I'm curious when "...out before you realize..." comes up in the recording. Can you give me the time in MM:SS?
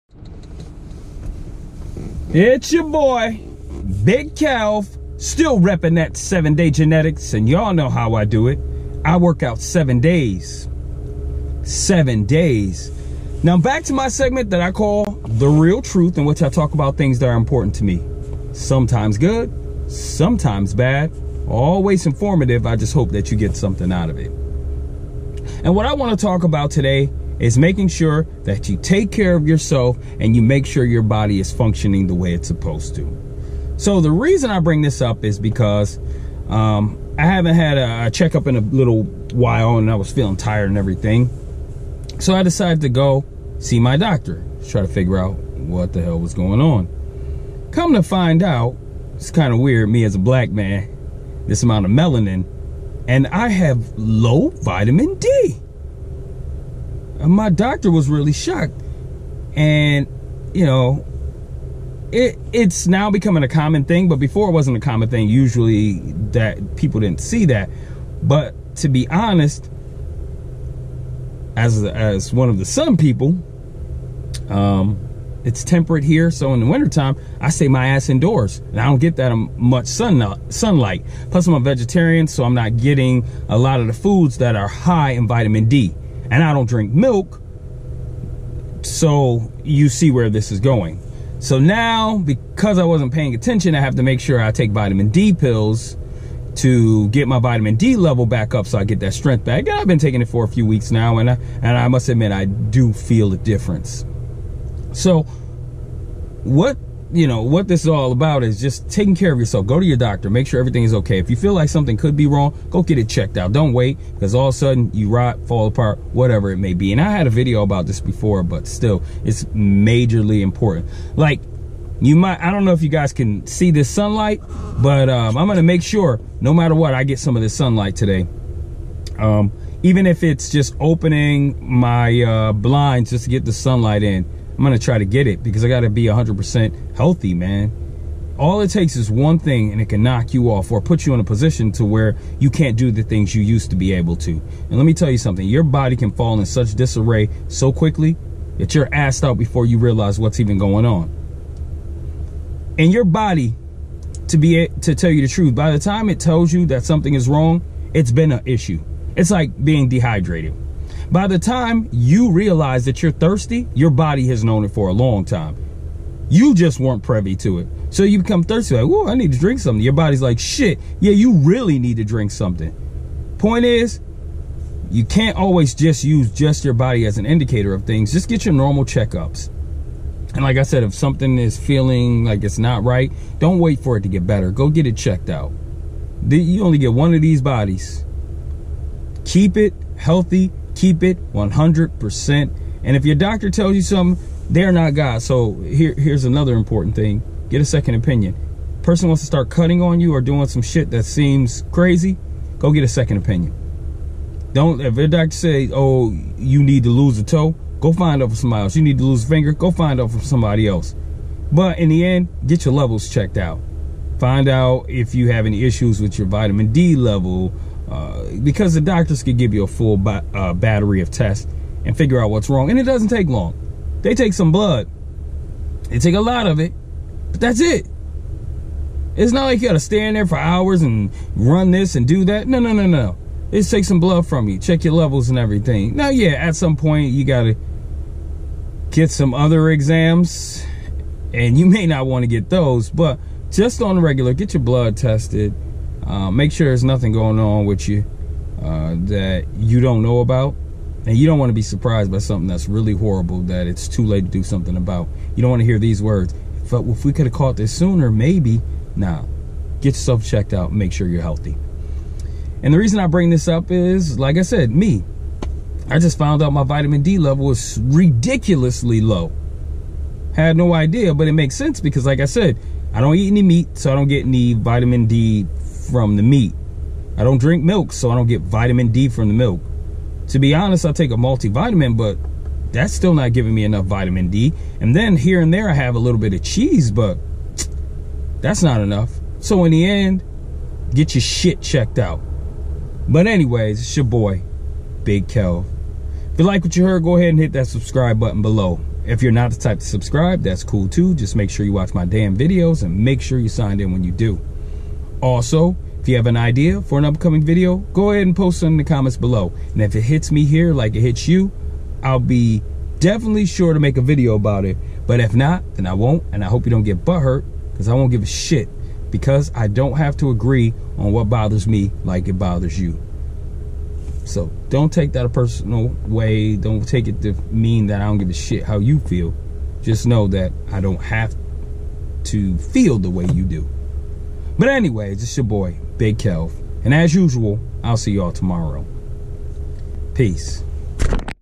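02:29.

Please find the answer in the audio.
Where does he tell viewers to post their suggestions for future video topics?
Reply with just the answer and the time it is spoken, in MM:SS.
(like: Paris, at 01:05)
The comments below, at 05:08.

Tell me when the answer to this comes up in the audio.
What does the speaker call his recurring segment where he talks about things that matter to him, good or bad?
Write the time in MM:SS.
00:15.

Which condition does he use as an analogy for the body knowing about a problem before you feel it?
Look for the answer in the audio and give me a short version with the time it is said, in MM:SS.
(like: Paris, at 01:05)
Being dehydrated, at 02:39.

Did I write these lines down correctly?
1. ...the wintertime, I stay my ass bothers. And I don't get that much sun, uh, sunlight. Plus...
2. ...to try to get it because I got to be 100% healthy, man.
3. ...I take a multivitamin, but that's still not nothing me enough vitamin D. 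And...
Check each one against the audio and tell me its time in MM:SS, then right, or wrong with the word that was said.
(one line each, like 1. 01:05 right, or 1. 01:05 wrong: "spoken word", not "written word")
1. 01:16 wrong: "indoors", not "bothers"
2. 02:14 right
3. 04:40 wrong: "giving", not "nothing".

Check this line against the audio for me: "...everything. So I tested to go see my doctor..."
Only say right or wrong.
wrong.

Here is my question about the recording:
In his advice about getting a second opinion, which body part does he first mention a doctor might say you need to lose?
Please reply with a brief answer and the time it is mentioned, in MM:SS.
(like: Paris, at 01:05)
A toe, at 03:27.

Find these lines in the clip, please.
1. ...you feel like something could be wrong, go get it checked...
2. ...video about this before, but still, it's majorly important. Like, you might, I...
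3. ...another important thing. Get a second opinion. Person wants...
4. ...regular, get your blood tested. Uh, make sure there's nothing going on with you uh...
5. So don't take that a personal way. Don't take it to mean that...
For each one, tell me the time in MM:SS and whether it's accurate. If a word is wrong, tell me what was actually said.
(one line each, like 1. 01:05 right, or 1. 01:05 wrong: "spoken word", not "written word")
1. 01:51 right
2. 01:57 right
3. 03:16 right
4. 04:04 right
5. 05:24 right.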